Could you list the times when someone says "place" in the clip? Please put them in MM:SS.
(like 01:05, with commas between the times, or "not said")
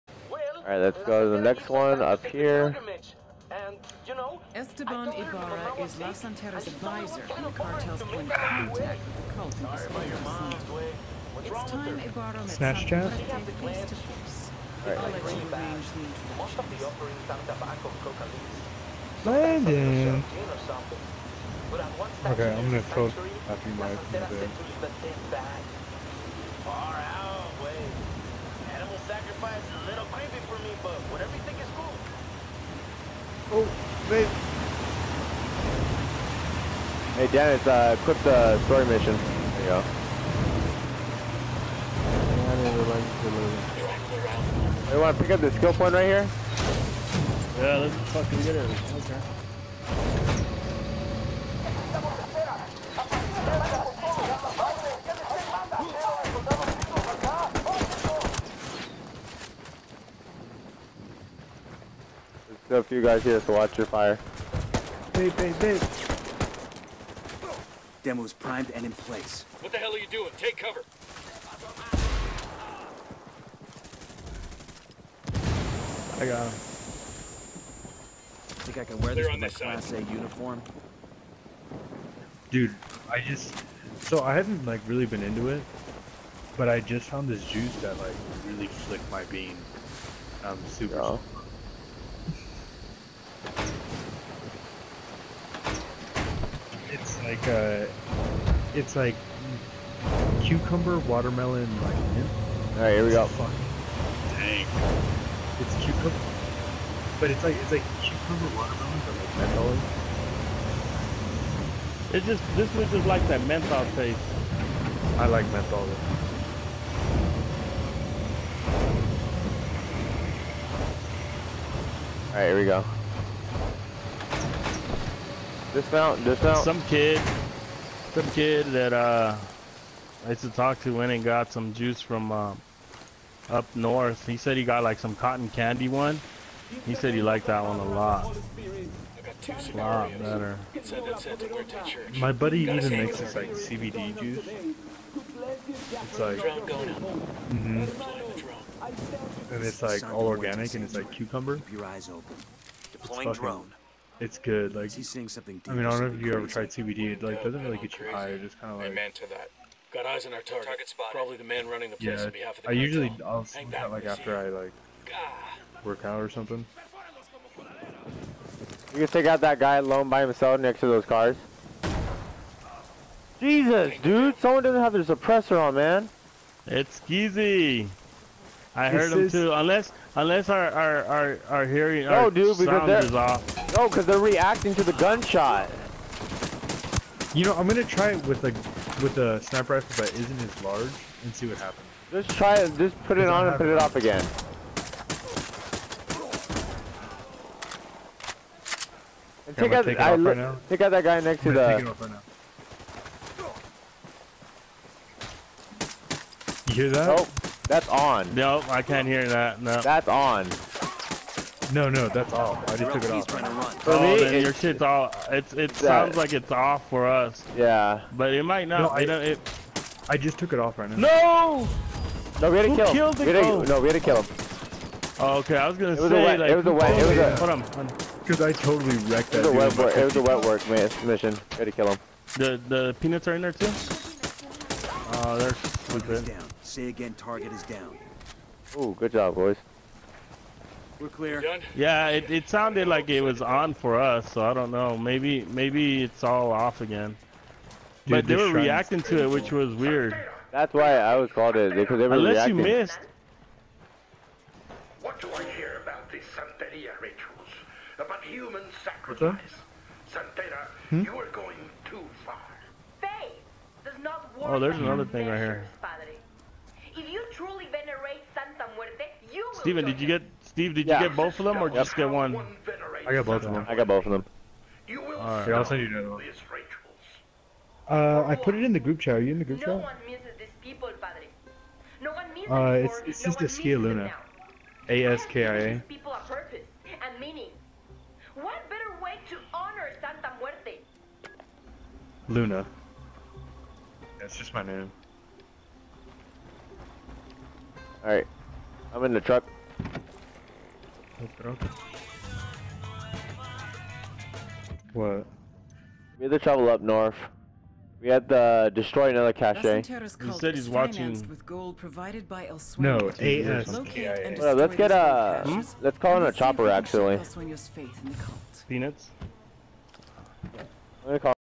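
01:08, 02:41.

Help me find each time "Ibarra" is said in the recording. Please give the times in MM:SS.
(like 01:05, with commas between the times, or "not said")
00:05, 00:11.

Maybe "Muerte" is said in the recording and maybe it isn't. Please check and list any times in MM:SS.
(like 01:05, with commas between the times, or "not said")
04:28, 04:50.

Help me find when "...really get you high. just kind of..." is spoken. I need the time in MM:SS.
02:37.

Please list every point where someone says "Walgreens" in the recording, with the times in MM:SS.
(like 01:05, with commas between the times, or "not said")
not said.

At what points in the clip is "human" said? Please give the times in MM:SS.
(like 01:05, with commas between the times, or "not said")
04:18.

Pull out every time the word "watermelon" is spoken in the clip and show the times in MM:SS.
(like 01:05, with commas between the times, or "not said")
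01:40, 01:48.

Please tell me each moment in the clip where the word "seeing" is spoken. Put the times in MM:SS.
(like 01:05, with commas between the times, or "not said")
02:35.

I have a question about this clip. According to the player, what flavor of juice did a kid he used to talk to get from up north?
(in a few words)
cotton candy.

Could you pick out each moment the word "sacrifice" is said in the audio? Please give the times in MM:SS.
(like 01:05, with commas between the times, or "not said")
00:29, 04:18.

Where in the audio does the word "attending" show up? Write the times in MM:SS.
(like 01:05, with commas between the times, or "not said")
not said.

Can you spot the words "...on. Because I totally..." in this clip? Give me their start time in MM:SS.
03:47.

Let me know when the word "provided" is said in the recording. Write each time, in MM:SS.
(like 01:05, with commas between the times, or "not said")
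05:11.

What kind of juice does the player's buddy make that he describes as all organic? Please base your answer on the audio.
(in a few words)
CBD juice.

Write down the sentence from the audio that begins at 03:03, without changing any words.
No, because they're reacting to the gunshot.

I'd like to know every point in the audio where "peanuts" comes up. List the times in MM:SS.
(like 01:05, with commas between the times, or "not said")
03:52, 05:18.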